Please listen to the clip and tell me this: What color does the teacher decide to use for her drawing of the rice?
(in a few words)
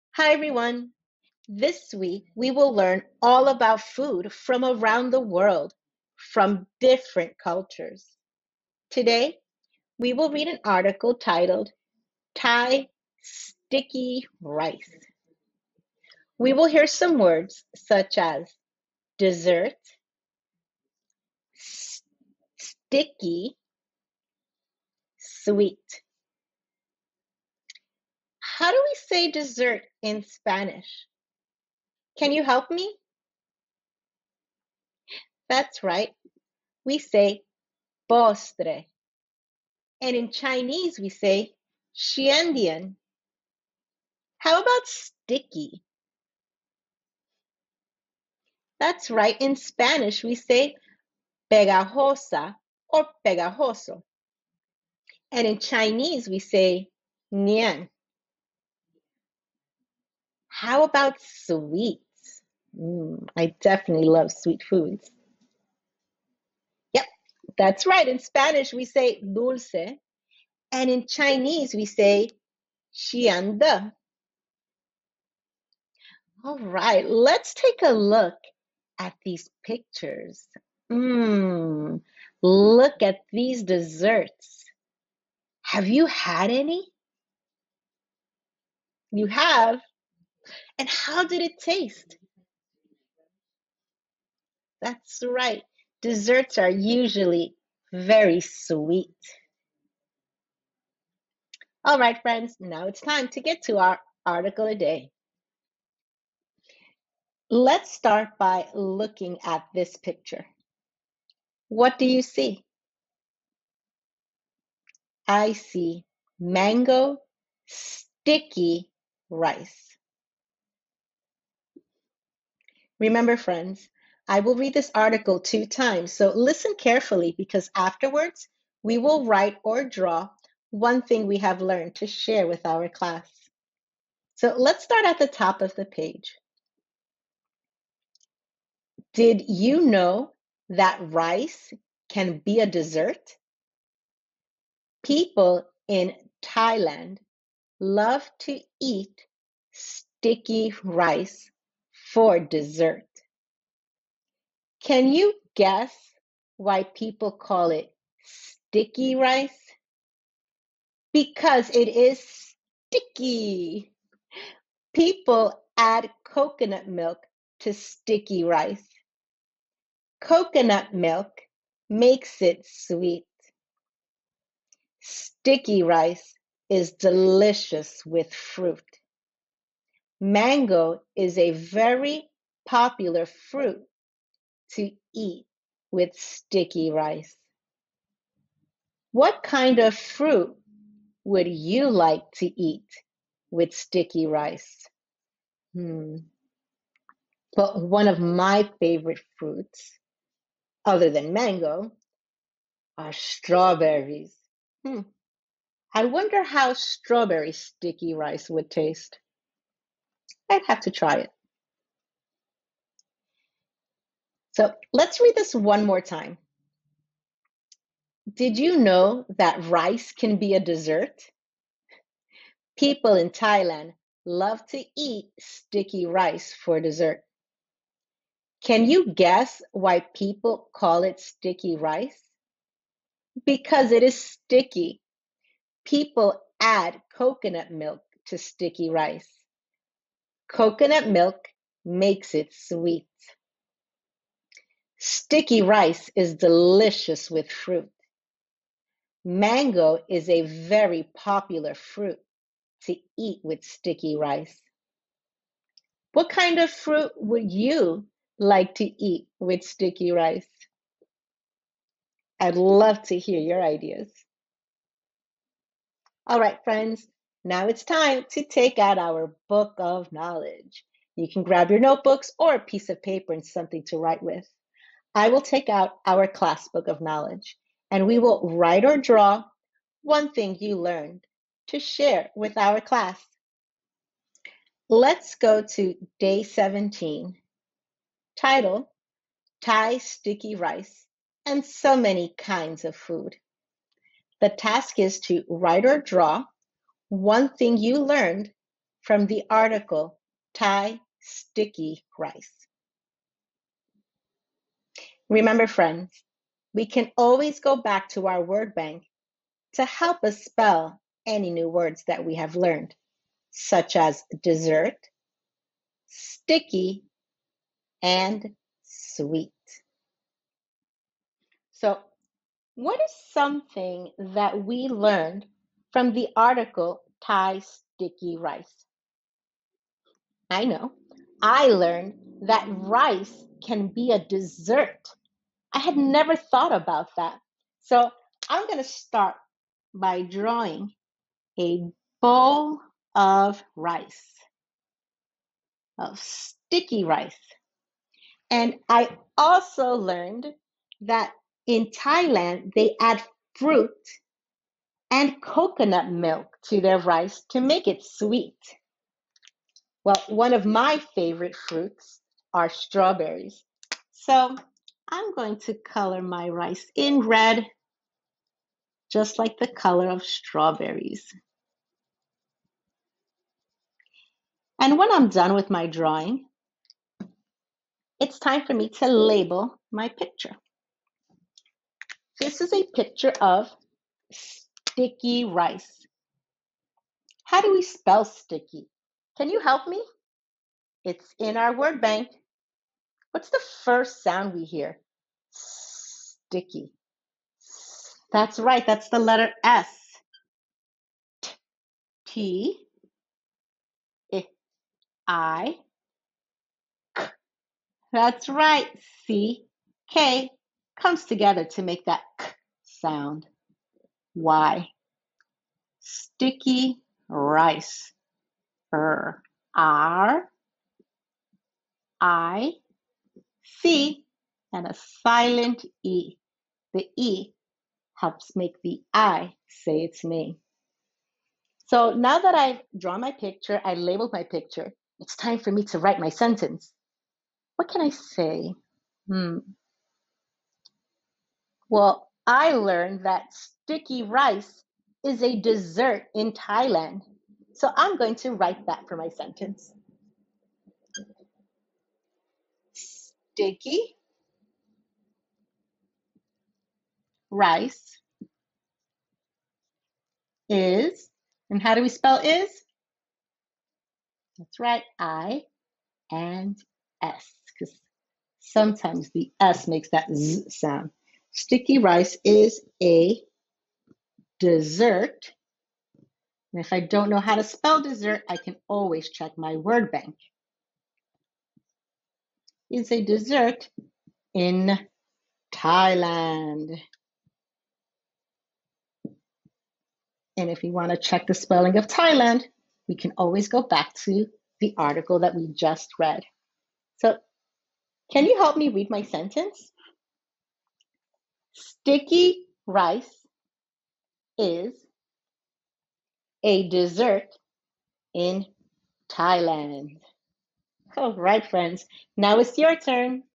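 red.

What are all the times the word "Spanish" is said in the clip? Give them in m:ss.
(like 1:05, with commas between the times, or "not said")
0:30, 0:49, 1:08.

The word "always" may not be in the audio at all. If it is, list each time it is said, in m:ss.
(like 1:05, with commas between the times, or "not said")
5:07, 7:58, 8:13.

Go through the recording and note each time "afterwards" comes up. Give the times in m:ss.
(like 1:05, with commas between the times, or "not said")
2:07.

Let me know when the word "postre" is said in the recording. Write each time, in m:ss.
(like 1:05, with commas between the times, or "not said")
0:38.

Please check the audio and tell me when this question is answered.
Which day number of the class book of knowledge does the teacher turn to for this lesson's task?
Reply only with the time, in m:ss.
4:46.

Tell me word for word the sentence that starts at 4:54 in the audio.
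The task is to write or draw one thing you learned from the article Thai Sticky Rice.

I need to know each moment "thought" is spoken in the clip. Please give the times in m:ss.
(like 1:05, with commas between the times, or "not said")
5:36.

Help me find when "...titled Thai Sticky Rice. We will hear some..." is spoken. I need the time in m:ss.
0:11.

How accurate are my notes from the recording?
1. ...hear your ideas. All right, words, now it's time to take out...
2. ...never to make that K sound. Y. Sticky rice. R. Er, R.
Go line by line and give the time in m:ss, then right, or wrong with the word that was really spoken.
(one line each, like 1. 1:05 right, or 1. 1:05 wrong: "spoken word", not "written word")
1. 4:23 wrong: "friends", not "words"
2. 6:51 wrong: "together", not "never".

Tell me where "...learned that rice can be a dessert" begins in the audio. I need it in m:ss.
5:31.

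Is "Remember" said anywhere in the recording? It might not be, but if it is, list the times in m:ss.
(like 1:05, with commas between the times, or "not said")
2:03, 5:05.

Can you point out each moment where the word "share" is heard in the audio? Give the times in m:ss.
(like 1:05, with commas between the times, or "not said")
2:12, 4:41.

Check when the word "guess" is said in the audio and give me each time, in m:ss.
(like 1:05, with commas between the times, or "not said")
2:35, 3:49.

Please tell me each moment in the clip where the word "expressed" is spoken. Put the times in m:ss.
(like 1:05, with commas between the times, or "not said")
not said.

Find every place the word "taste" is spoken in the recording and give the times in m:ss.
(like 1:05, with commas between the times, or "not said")
1:31, 3:28.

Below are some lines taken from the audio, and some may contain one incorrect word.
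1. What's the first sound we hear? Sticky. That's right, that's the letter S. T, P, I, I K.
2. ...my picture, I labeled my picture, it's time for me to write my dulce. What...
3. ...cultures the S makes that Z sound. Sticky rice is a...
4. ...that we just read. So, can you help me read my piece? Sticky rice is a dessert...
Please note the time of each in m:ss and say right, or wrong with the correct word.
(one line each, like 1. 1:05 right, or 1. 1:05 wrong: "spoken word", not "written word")
1. 6:33 right
2. 7:13 wrong: "sentence", not "dulce"
3. 7:48 wrong: "sometimes", not "cultures"
4. 8:15 wrong: "sentence", not "piece".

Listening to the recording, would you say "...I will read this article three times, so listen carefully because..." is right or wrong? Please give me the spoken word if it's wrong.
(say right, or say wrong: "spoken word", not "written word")
wrong: "two", not "three".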